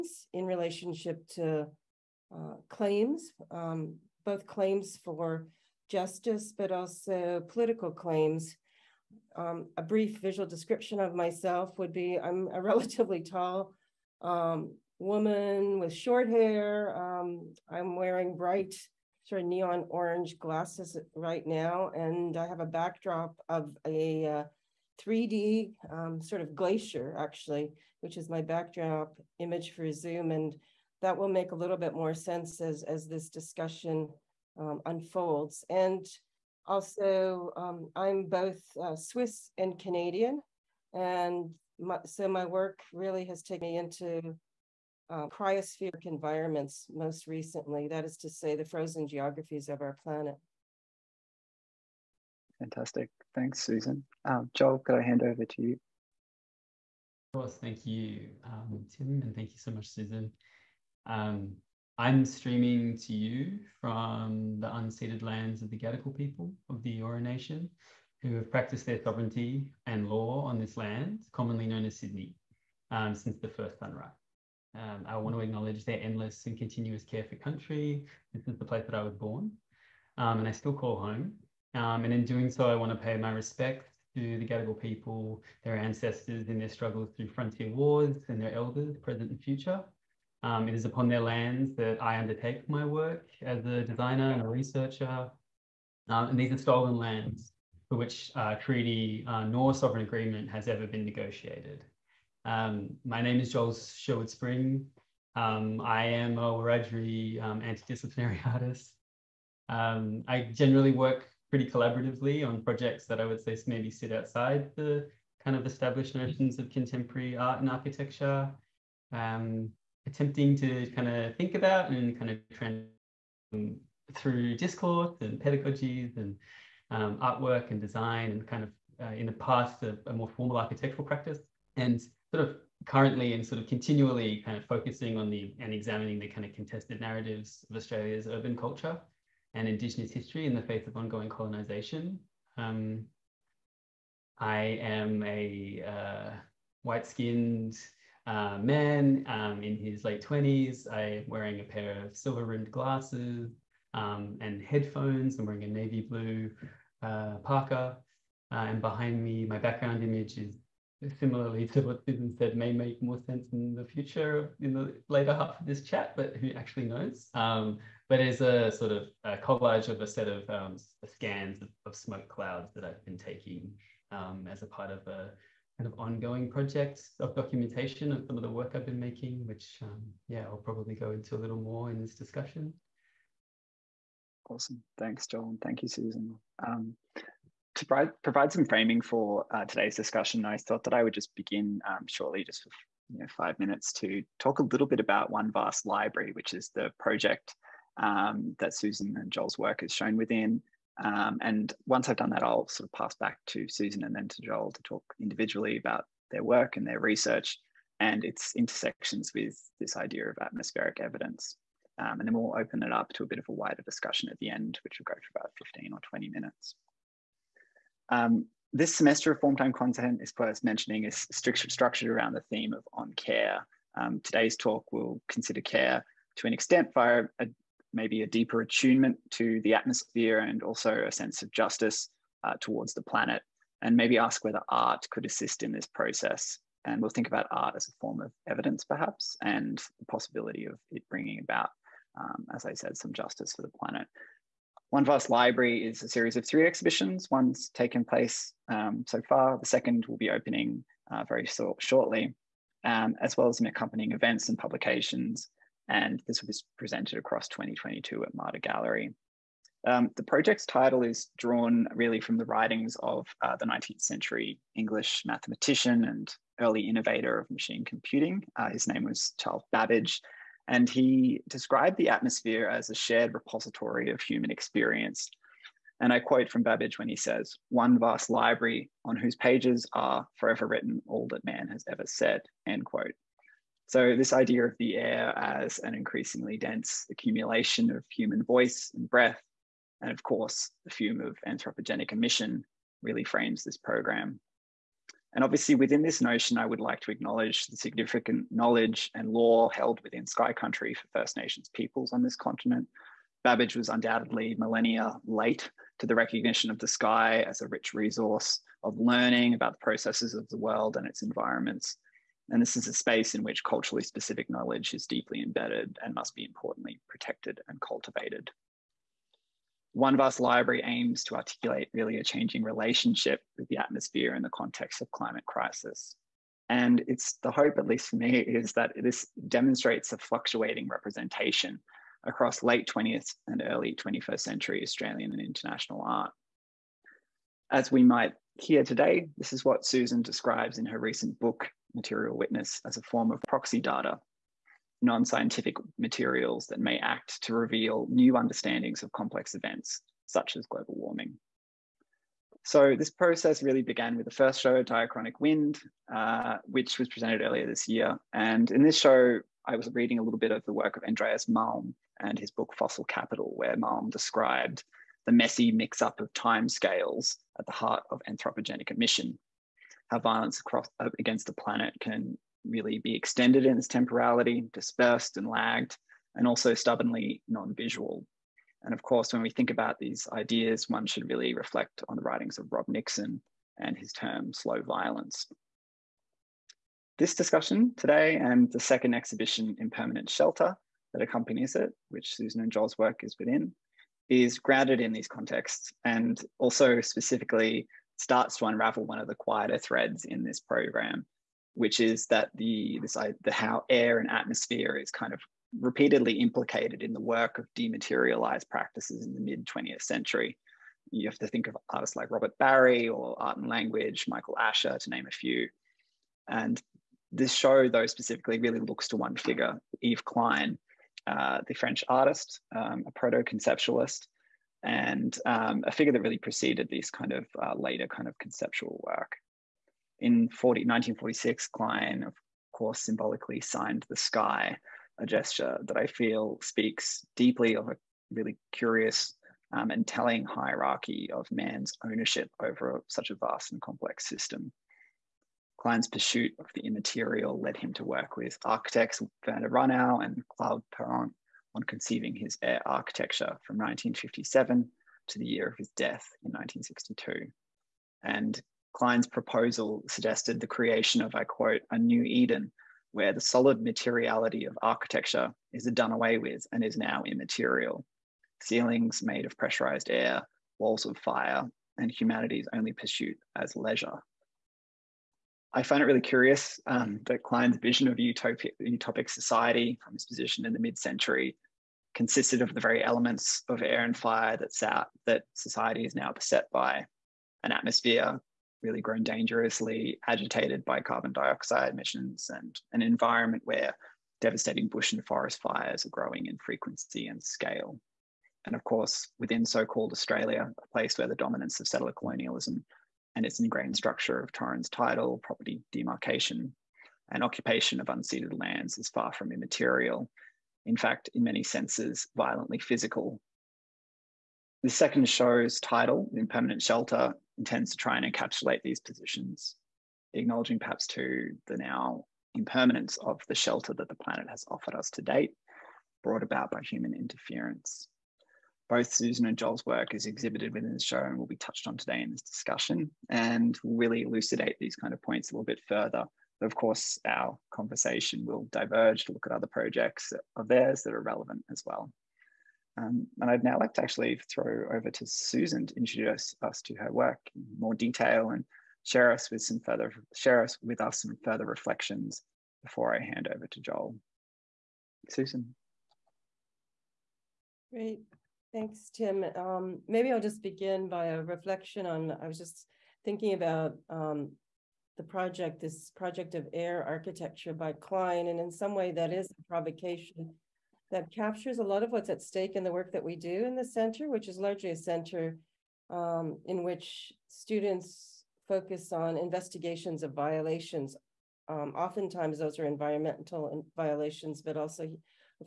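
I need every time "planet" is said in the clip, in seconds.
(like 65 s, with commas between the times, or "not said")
50 s, 233 s, 243 s, 371 s, 524 s.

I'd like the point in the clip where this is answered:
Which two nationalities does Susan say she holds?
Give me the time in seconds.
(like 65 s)
38 s.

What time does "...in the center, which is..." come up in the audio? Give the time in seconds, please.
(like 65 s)
573 s.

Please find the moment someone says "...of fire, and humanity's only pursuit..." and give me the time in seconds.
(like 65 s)
471 s.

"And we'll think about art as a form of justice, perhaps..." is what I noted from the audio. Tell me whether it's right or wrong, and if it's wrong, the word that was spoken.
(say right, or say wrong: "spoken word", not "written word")
wrong: "evidence", not "justice".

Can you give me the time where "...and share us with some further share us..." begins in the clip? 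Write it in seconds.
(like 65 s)
548 s.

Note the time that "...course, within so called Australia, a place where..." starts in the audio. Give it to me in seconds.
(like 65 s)
498 s.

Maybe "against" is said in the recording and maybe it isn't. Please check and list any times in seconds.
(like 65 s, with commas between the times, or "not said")
371 s.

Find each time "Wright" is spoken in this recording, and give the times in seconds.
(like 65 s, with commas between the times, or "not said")
not said.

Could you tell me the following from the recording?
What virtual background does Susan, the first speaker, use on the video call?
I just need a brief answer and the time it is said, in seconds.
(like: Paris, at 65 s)
A 3D glacier, at 25 s.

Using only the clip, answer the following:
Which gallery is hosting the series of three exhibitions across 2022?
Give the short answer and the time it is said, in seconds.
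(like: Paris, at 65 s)
MADA Gallery, at 258 s.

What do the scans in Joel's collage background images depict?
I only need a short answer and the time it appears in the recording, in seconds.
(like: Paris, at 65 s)
Smoke clouds, at 171 s.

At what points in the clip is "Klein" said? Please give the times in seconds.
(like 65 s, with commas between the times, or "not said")
420 s, 431 s, 445 s, 458 s, 477 s, 567 s.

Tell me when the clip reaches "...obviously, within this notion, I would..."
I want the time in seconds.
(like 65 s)
295 s.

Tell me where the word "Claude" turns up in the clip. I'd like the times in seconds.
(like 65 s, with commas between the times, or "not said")
450 s.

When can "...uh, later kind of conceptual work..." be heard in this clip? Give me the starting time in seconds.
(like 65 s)
427 s.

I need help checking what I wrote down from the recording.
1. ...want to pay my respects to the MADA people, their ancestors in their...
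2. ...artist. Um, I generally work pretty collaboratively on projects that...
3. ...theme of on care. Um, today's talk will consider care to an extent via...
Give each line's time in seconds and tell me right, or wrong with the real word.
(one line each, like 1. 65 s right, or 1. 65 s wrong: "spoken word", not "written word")
1. 82 s wrong: "Gadigal", not "MADA"
2. 108 s right
3. 222 s right.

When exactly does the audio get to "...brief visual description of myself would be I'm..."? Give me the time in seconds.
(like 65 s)
9 s.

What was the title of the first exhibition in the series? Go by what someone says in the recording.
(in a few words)
Diachronic Wind.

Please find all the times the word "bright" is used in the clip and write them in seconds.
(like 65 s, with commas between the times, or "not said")
18 s.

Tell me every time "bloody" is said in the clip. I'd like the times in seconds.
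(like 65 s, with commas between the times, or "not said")
not said.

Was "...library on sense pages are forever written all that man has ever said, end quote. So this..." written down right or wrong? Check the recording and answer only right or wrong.
wrong.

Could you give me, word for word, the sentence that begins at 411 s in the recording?
You have to think of artists like Robert Barry or Art and Language, Michael Asher, to name a few.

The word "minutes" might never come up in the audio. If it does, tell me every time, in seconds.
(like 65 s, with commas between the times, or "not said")
193 s, 216 s.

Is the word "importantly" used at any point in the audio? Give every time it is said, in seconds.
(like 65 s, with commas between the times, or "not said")
316 s.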